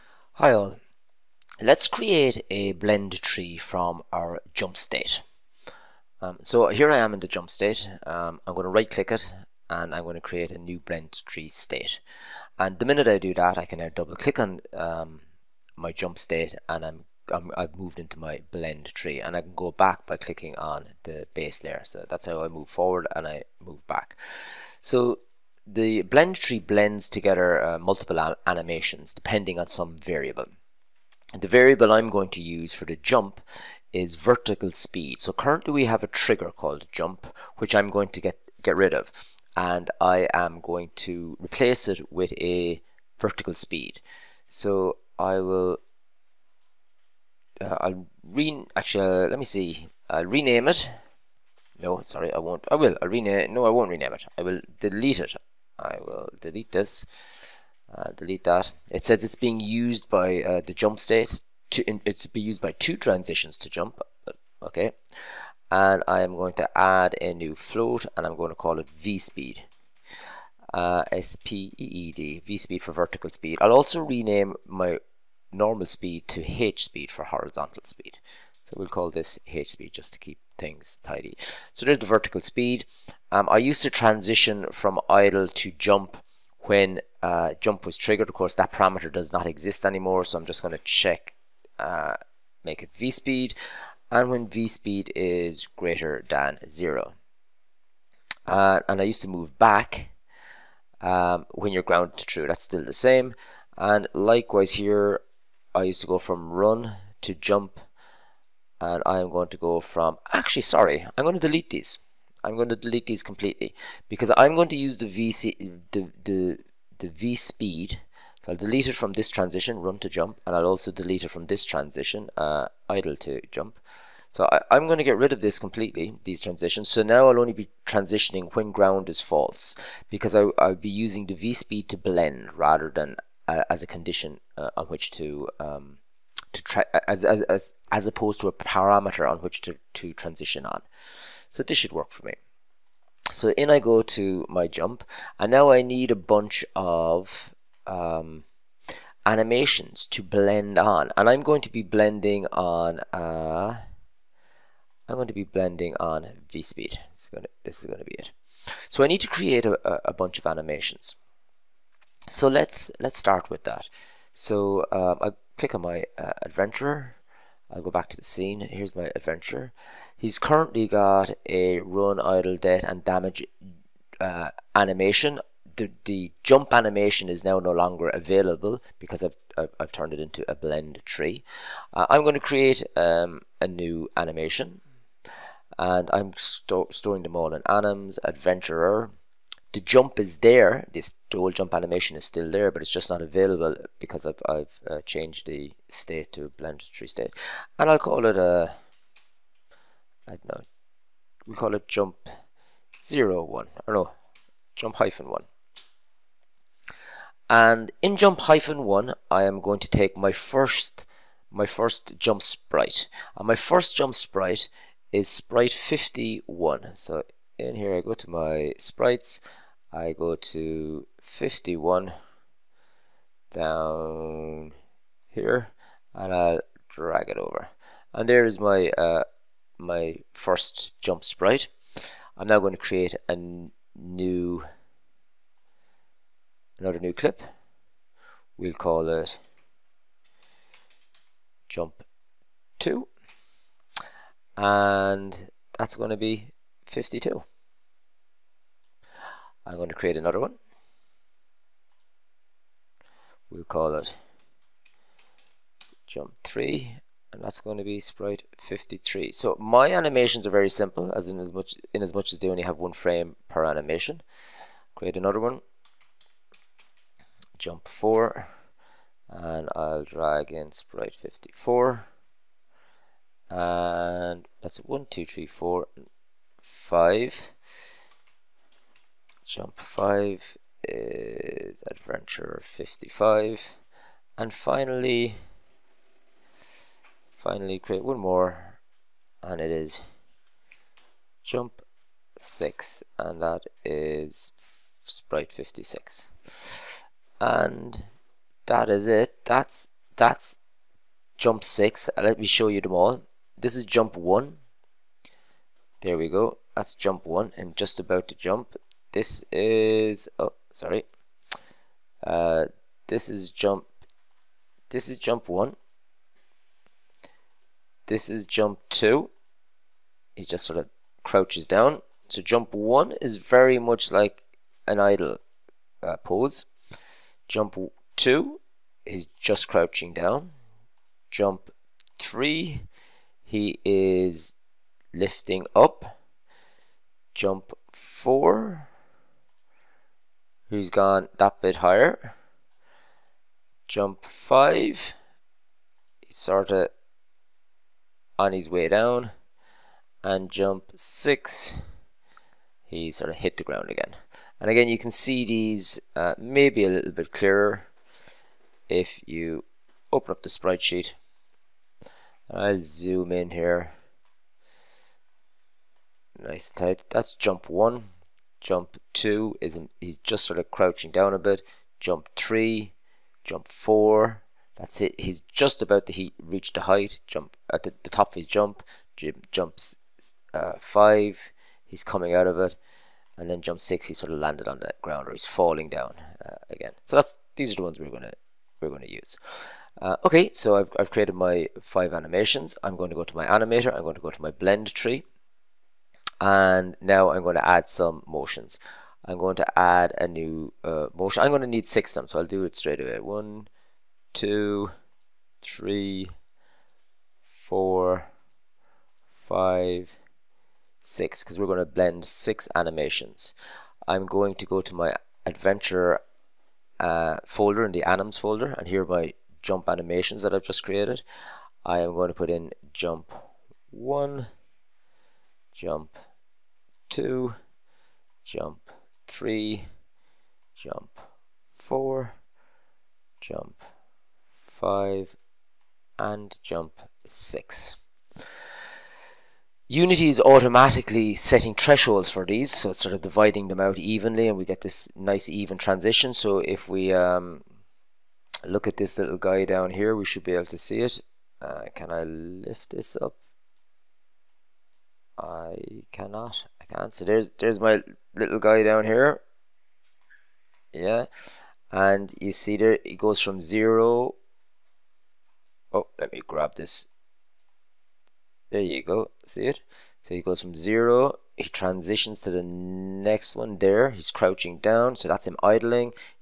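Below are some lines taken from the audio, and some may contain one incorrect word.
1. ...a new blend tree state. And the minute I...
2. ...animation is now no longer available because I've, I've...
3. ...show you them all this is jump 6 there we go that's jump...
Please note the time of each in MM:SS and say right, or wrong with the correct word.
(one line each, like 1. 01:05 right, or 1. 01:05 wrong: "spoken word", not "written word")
1. 00:10 right
2. 02:56 right
3. 05:02 wrong: "1", not "6".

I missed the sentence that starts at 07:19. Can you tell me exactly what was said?
Unity is automatically setting thresholds for these, so it's sort of dividing them out evenly, and we get this nice even transition.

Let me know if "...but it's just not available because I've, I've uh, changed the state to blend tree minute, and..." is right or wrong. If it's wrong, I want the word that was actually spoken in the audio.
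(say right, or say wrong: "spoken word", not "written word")
wrong: "state", not "minute".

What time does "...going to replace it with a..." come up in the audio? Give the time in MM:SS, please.
00:40.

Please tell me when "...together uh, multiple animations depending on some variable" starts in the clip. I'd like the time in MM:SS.
00:27.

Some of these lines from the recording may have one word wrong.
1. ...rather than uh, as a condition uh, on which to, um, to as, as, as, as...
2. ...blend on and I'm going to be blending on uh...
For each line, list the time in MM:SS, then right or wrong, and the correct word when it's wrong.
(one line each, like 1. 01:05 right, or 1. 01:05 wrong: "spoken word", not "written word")
1. 02:12 right
2. 02:30 right.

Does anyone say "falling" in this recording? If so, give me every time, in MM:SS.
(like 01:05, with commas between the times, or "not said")
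06:25.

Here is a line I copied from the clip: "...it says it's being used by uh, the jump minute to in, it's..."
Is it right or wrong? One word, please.
wrong.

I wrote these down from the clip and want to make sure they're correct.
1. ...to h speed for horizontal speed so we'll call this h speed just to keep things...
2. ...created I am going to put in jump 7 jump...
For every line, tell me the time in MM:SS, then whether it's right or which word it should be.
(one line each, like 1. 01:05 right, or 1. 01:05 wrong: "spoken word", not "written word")
1. 01:16 right
2. 07:00 wrong: "1", not "7".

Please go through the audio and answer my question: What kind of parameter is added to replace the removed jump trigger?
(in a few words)
float.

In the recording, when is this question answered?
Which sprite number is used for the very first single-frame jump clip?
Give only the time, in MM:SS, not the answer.
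03:35.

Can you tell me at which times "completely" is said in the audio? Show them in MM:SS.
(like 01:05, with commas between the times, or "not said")
01:53, 02:05.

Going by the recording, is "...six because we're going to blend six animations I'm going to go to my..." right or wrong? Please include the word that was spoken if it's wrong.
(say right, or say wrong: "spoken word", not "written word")
right.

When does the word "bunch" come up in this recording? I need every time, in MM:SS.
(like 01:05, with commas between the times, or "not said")
02:26, 02:40.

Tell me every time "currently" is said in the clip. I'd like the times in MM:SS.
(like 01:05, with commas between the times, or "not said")
00:35, 02:50.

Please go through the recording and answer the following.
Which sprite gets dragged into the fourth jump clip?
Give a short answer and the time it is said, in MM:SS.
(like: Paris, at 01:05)
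54, at 04:30.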